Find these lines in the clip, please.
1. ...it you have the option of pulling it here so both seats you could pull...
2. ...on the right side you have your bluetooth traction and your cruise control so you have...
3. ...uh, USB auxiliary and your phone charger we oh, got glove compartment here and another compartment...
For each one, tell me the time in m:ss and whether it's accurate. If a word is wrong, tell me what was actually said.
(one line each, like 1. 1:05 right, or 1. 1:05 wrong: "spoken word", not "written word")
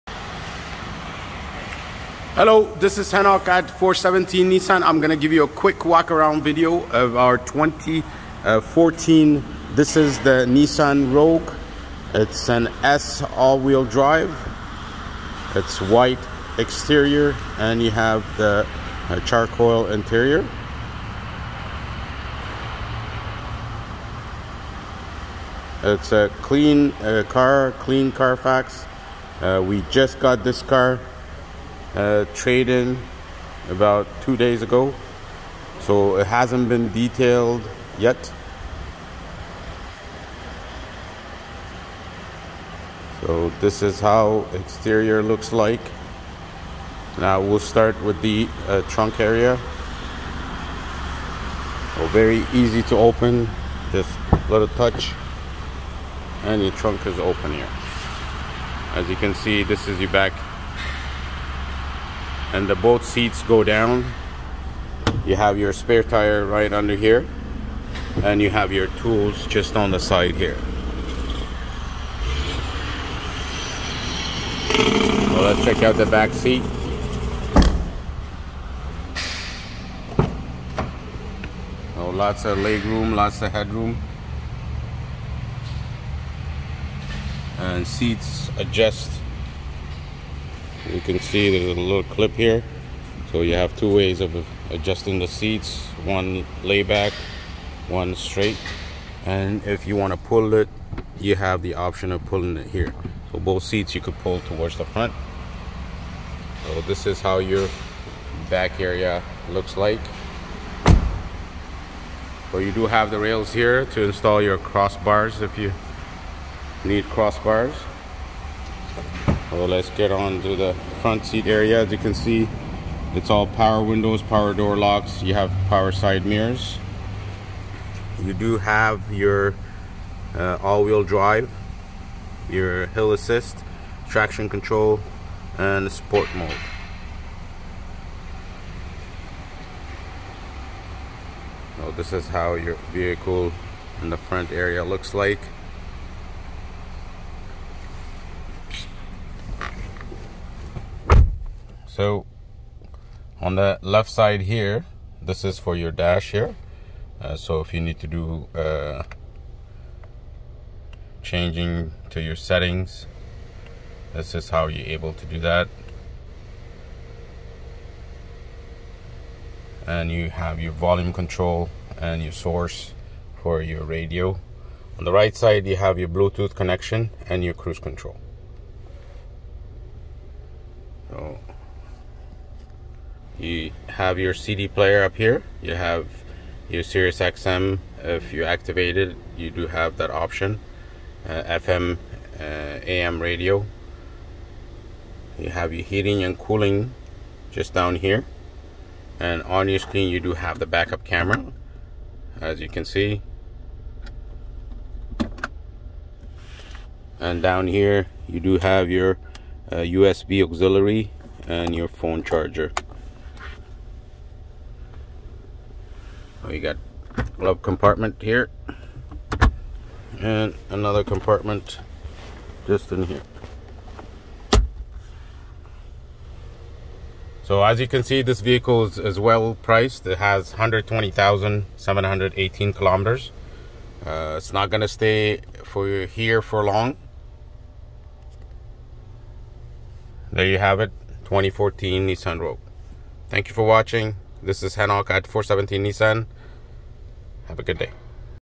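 1. 1:40 right
2. 2:54 wrong: "connection", not "traction"
3. 3:29 right.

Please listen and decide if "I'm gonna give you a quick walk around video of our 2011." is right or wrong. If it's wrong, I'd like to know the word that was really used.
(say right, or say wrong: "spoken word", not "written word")
wrong: "2014", not "2011".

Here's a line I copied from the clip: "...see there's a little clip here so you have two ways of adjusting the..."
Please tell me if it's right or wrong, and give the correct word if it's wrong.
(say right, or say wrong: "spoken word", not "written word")
right.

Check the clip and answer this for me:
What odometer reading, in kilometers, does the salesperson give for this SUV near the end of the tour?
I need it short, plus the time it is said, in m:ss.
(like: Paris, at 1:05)
120,718 kilometers, at 3:50.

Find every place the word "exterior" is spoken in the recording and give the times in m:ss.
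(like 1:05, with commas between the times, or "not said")
0:16, 0:44.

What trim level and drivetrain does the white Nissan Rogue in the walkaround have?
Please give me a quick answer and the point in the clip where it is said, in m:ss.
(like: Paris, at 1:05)
S all-wheel drive, at 0:12.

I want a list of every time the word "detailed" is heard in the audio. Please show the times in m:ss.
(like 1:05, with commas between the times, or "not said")
0:36.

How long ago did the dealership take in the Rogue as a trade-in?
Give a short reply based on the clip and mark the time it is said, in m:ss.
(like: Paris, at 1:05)
About 2 days, at 0:33.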